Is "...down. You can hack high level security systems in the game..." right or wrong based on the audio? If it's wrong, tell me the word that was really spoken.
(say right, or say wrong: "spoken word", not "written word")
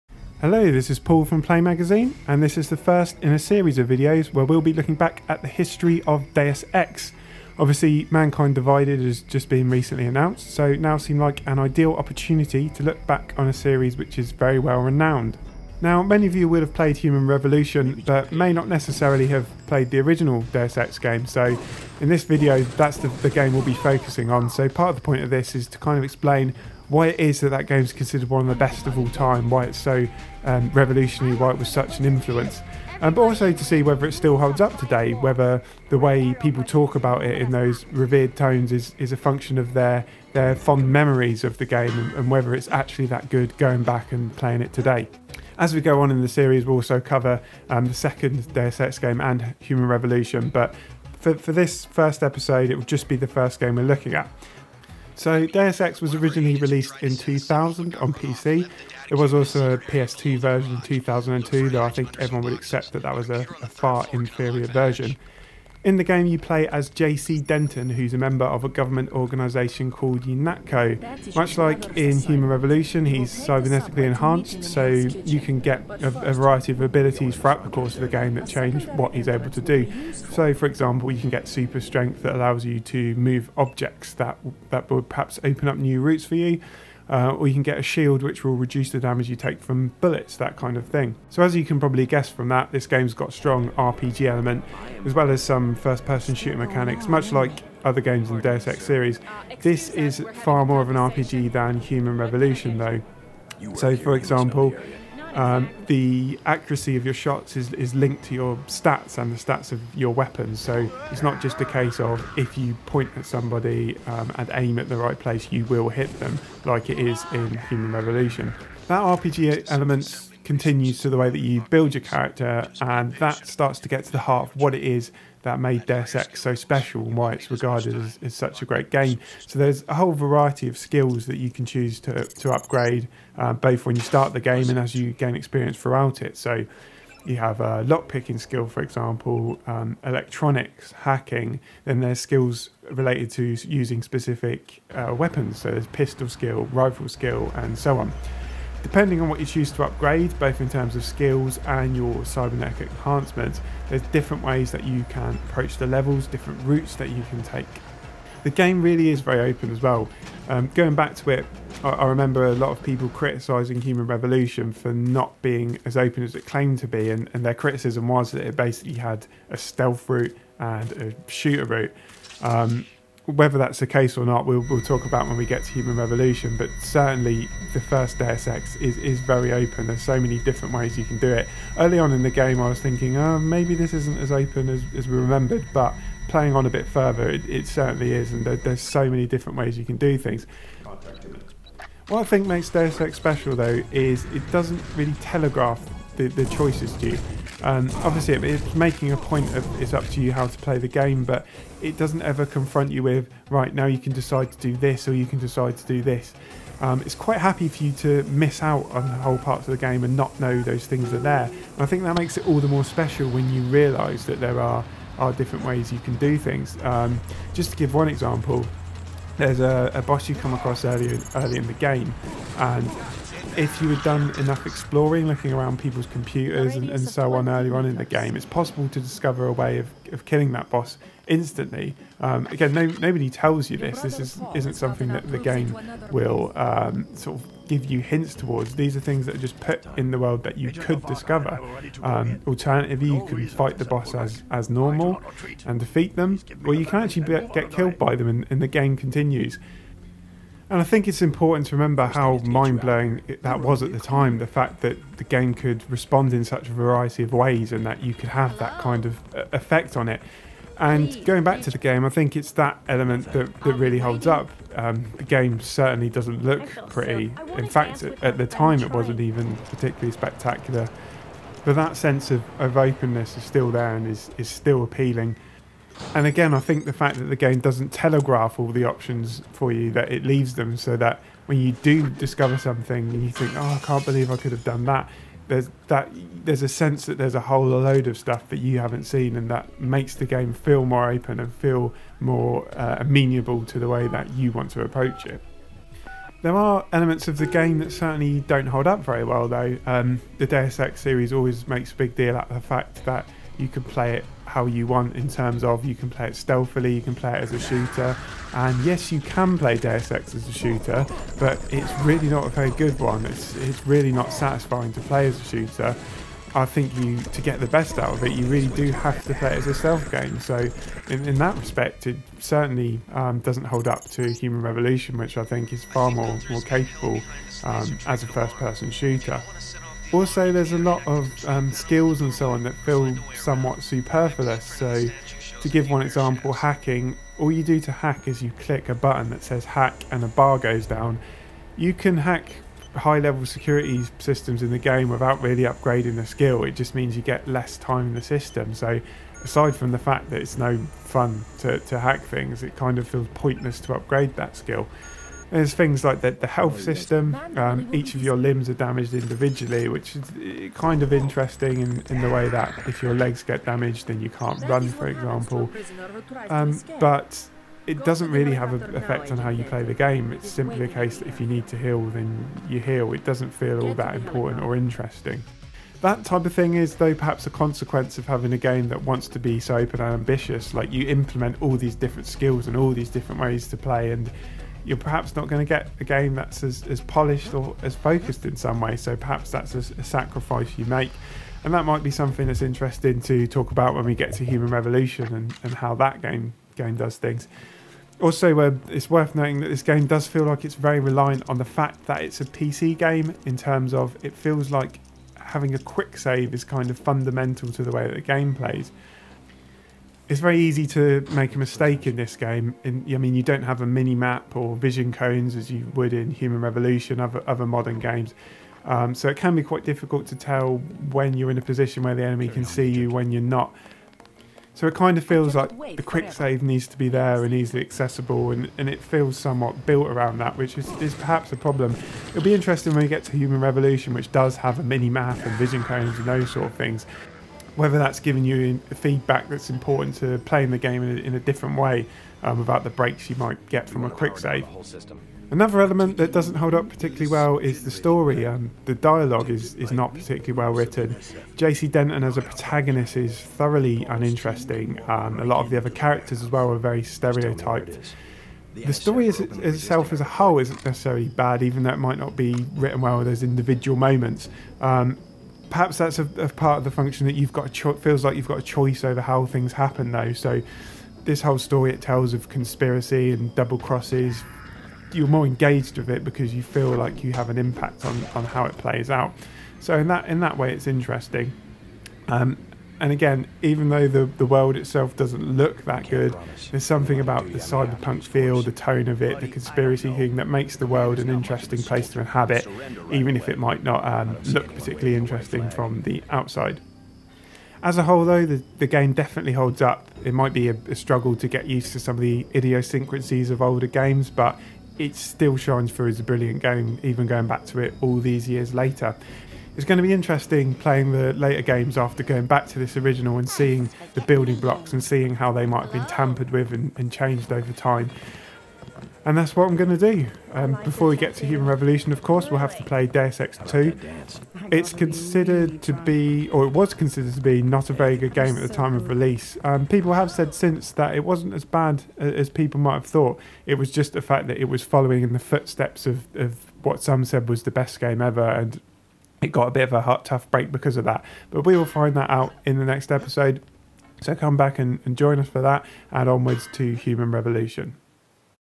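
right.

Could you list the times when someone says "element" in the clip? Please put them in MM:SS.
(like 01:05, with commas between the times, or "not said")
01:34, 01:59, 04:22, 04:56, 07:25.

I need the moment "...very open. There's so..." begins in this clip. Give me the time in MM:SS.
02:59.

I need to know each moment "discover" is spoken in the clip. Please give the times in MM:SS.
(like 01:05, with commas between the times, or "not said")
03:48, 04:01, 04:42.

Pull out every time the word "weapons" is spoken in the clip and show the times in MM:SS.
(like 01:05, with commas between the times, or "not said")
01:50, 02:25.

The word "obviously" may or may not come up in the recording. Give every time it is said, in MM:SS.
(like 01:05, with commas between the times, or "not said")
00:07, 03:17.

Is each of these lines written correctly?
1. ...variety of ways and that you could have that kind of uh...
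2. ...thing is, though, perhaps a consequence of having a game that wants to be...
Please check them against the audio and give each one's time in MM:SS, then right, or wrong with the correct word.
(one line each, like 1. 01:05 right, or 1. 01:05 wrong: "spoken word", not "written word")
1. 04:16 right
2. 06:16 right.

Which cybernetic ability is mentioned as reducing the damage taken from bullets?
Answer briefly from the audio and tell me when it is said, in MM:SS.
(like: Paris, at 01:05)
a shield, at 01:27.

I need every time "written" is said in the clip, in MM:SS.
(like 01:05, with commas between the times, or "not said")
07:30, 07:42.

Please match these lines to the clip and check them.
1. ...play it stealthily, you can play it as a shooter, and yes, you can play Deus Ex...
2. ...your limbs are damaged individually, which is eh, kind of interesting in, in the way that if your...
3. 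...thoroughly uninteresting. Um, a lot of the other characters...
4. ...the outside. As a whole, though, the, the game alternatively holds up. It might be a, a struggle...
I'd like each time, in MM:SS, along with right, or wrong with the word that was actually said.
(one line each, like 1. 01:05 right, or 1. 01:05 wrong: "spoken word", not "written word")
1. 05:06 right
2. 05:58 right
3. 07:33 right
4. 08:16 wrong: "definitely", not "alternatively".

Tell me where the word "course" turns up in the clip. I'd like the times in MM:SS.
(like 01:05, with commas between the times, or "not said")
01:17, 08:42.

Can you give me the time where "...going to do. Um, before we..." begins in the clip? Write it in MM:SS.
08:39.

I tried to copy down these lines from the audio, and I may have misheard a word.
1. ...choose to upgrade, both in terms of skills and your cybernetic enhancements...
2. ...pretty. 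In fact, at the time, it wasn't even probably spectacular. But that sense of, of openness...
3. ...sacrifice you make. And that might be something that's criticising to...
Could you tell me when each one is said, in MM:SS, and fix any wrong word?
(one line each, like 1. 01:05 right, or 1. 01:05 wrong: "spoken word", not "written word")
1. 02:29 right
2. 04:26 wrong: "particularly", not "probably"
3. 06:30 wrong: "interesting", not "criticising".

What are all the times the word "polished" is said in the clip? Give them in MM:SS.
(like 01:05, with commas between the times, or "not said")
06:27.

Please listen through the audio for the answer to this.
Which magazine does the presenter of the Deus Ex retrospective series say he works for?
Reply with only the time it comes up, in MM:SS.
00:01.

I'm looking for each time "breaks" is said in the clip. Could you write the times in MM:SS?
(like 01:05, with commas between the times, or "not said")
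07:22, 09:00.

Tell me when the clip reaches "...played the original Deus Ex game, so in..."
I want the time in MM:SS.
00:19.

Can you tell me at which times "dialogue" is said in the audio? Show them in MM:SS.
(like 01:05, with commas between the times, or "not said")
07:28.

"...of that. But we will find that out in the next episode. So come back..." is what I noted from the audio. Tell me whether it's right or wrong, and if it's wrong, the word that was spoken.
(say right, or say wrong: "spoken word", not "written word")
right.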